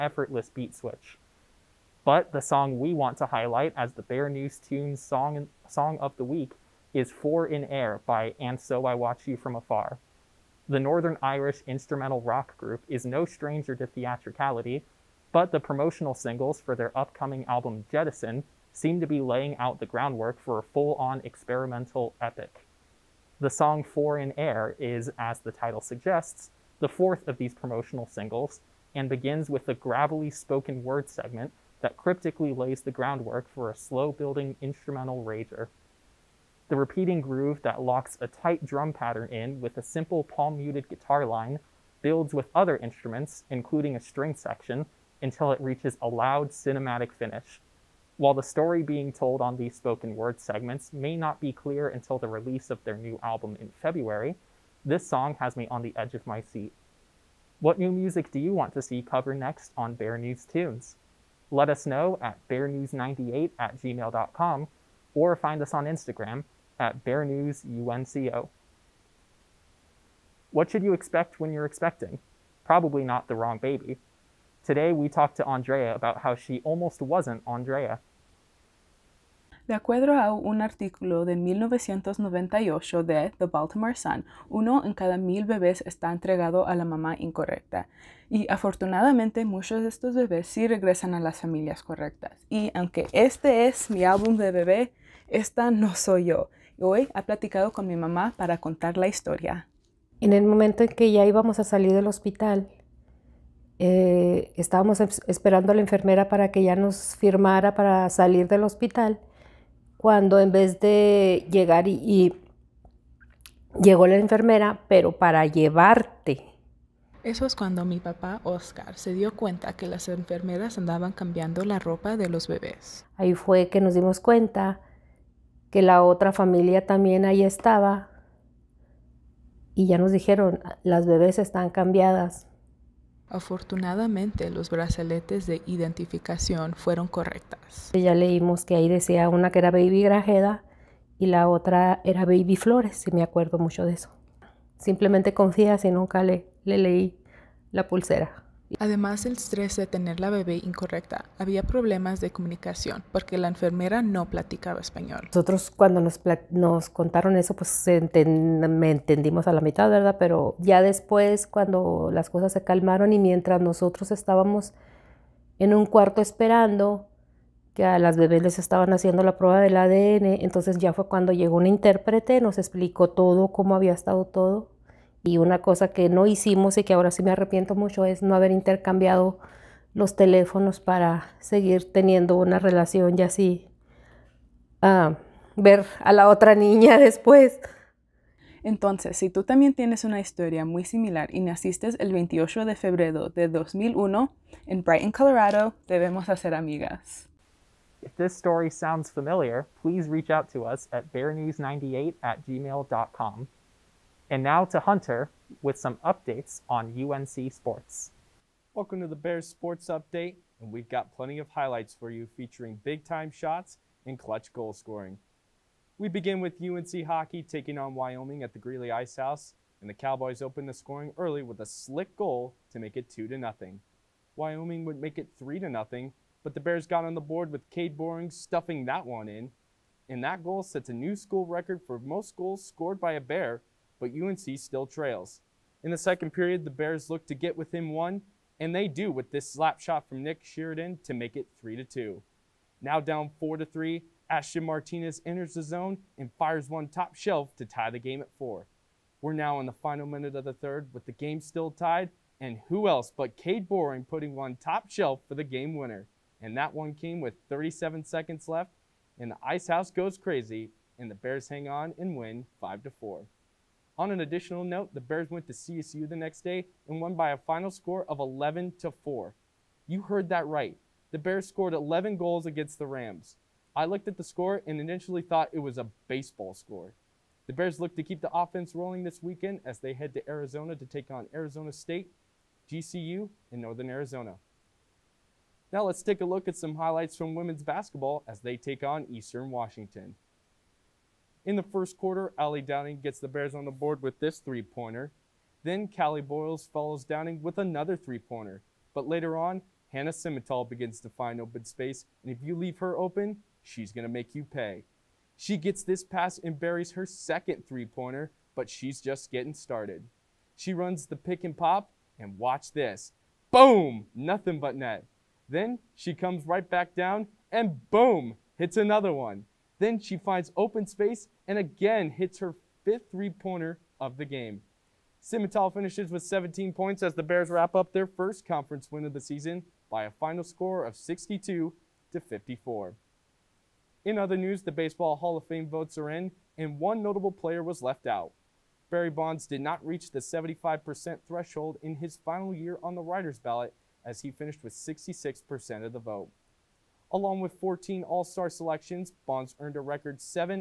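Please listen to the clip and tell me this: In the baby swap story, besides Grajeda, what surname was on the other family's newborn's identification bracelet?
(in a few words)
Flores.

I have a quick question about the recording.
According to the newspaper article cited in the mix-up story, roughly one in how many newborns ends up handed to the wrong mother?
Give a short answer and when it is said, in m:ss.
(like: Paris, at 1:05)
1000, at 1:24.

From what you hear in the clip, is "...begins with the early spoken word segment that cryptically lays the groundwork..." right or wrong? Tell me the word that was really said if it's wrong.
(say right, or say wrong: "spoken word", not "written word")
wrong: "gravelly", not "early".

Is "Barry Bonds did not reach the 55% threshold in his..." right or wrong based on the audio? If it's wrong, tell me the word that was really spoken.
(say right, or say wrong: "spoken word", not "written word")
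wrong: "75", not "55".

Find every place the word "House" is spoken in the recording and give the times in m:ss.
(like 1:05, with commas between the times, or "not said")
3:39, 4:19.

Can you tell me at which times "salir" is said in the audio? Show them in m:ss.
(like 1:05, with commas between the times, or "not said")
1:41, 1:48.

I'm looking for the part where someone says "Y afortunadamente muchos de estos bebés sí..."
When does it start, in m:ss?
1:28.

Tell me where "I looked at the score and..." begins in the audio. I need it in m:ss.
4:33.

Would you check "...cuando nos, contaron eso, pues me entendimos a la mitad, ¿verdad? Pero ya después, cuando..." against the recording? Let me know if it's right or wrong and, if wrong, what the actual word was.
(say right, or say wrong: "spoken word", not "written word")
right.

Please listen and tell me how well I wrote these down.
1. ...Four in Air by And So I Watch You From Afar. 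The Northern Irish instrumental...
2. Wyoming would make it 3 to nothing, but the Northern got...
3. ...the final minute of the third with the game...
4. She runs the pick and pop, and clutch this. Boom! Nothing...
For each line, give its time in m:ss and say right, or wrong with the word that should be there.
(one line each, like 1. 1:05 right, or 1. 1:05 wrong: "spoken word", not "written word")
1. 0:07 right
2. 3:44 wrong: "Bears", not "Northern"
3. 4:09 right
4. 5:10 wrong: "watch", not "clutch".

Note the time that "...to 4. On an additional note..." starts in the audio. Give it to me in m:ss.
4:22.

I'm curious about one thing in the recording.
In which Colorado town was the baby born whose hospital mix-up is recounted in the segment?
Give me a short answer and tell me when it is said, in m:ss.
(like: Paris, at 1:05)
Brighton, at 3:14.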